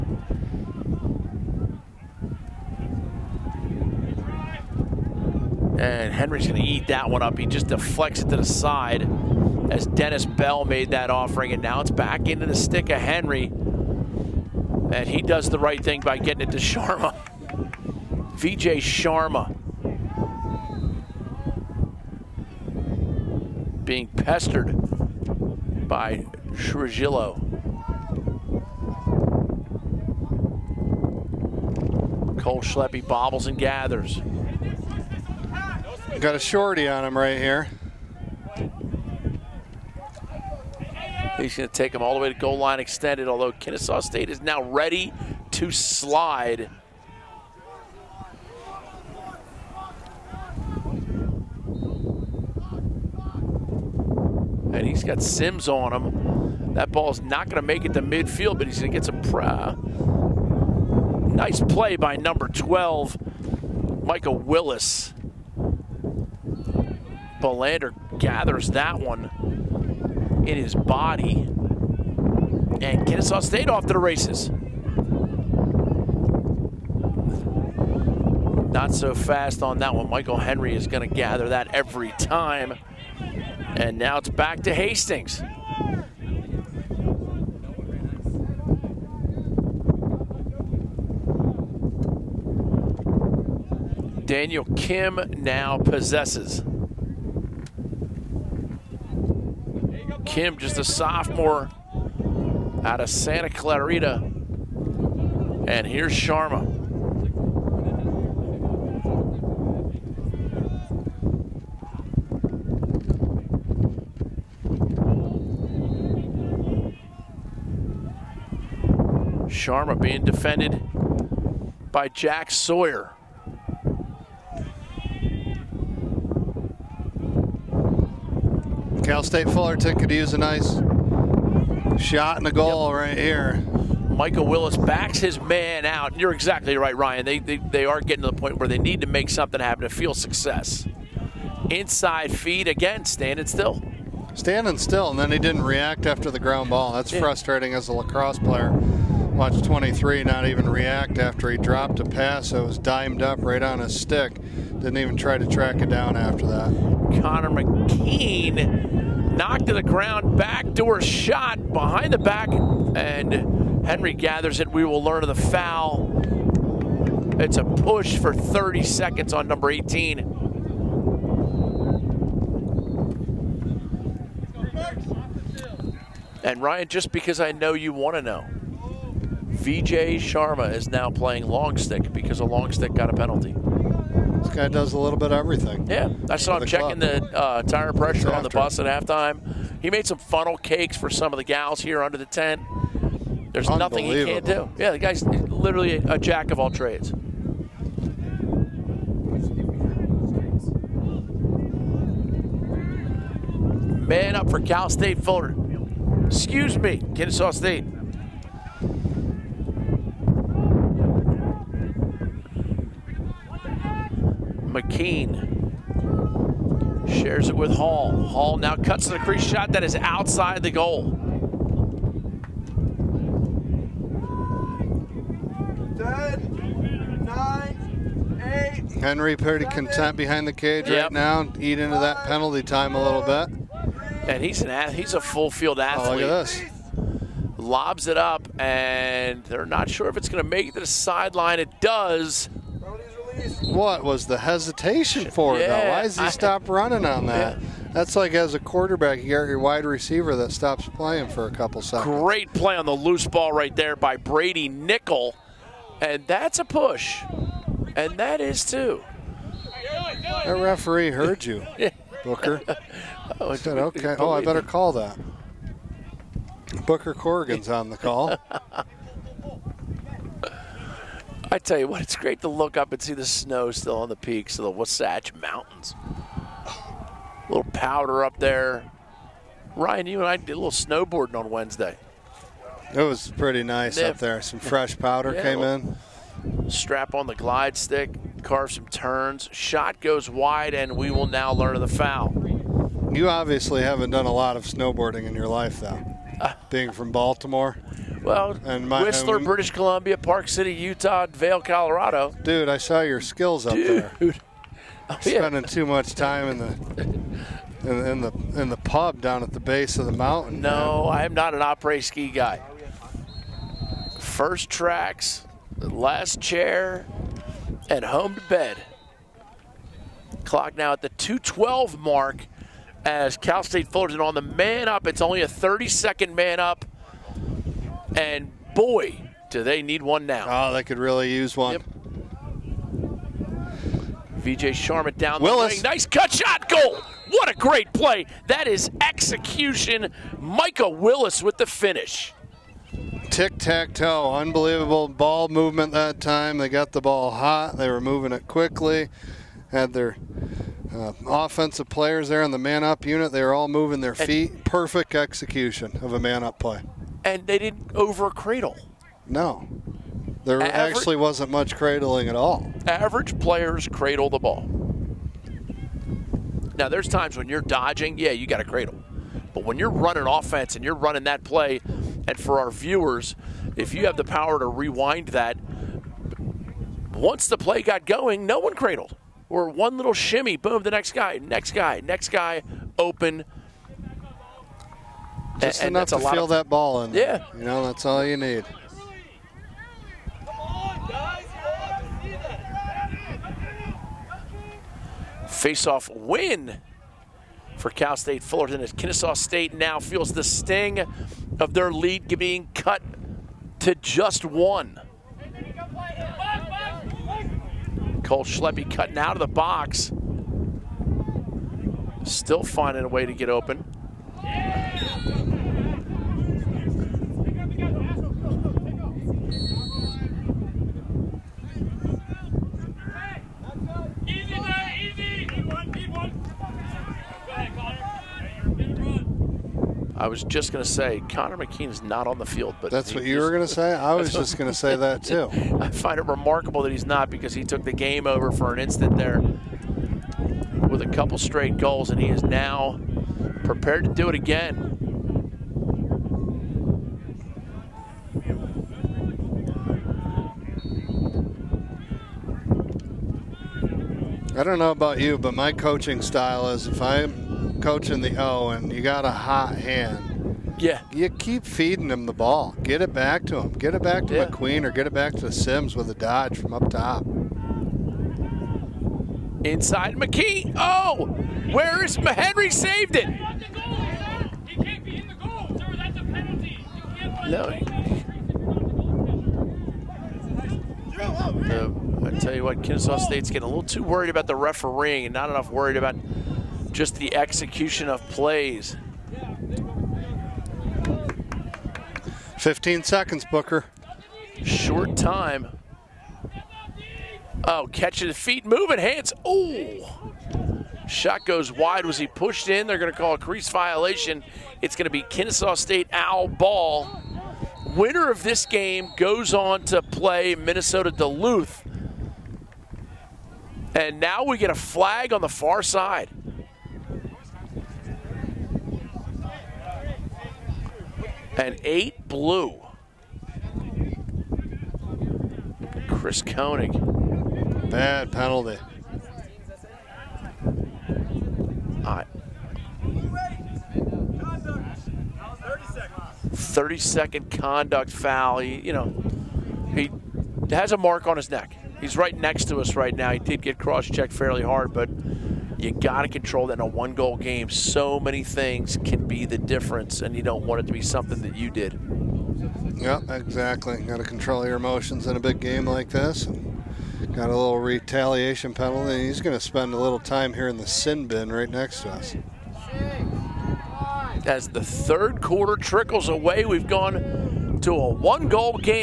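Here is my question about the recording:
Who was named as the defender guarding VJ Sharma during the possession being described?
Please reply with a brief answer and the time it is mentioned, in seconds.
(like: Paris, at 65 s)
Jack Sawyer, at 122 s.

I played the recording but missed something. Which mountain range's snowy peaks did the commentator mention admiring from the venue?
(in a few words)
Wasatch Mountains.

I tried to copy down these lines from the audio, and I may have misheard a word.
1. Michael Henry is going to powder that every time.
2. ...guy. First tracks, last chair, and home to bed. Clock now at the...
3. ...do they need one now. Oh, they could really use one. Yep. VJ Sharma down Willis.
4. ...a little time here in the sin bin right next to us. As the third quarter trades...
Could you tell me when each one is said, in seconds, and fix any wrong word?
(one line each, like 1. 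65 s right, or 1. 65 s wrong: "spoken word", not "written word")
1. 80 s wrong: "gather", not "powder"
2. 312 s right
3. 329 s right
4. 559 s wrong: "trickles", not "trades".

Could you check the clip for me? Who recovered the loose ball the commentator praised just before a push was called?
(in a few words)
Brady Nickel.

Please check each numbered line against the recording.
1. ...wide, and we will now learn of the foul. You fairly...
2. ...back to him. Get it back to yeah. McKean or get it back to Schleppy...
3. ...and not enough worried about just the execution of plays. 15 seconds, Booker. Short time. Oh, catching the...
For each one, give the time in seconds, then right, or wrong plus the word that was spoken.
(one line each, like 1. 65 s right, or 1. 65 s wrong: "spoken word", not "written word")
1. 290 s wrong: "obviously", not "fairly"
2. 463 s wrong: "Sims", not "Schleppy"
3. 485 s right.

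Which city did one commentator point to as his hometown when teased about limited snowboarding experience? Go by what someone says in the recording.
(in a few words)
Baltimore.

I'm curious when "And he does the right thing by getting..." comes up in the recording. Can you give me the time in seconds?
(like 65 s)
13 s.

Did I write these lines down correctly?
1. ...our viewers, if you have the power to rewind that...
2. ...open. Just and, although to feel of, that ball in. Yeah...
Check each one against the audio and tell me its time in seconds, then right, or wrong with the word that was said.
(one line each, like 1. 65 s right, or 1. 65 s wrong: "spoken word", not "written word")
1. 372 s right
2. 382 s wrong: "enough", not "although".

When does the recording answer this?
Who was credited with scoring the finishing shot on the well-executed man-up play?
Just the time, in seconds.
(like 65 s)
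340 s.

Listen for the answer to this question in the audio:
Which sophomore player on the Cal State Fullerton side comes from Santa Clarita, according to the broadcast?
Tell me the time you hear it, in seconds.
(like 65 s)
94 s.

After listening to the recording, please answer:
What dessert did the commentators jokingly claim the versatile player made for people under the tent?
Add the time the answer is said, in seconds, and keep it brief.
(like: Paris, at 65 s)
Funnel cakes, at 190 s.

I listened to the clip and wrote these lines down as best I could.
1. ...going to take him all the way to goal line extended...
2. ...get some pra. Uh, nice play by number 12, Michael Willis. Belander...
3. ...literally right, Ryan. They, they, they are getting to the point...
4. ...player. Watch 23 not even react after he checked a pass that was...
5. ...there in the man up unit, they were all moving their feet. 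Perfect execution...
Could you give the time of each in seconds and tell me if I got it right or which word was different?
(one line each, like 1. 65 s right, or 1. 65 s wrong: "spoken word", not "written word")
1. 41 s right
2. 58 s right
3. 136 s wrong: "exactly", not "literally"
4. 148 s wrong: "dropped", not "checked"
5. 352 s right.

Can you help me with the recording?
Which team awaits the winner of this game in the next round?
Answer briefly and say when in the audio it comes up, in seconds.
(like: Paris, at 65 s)
Minnesota Duluth, at 510 s.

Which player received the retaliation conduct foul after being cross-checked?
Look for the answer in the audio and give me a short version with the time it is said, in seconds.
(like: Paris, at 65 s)
Chris Koenig, at 526 s.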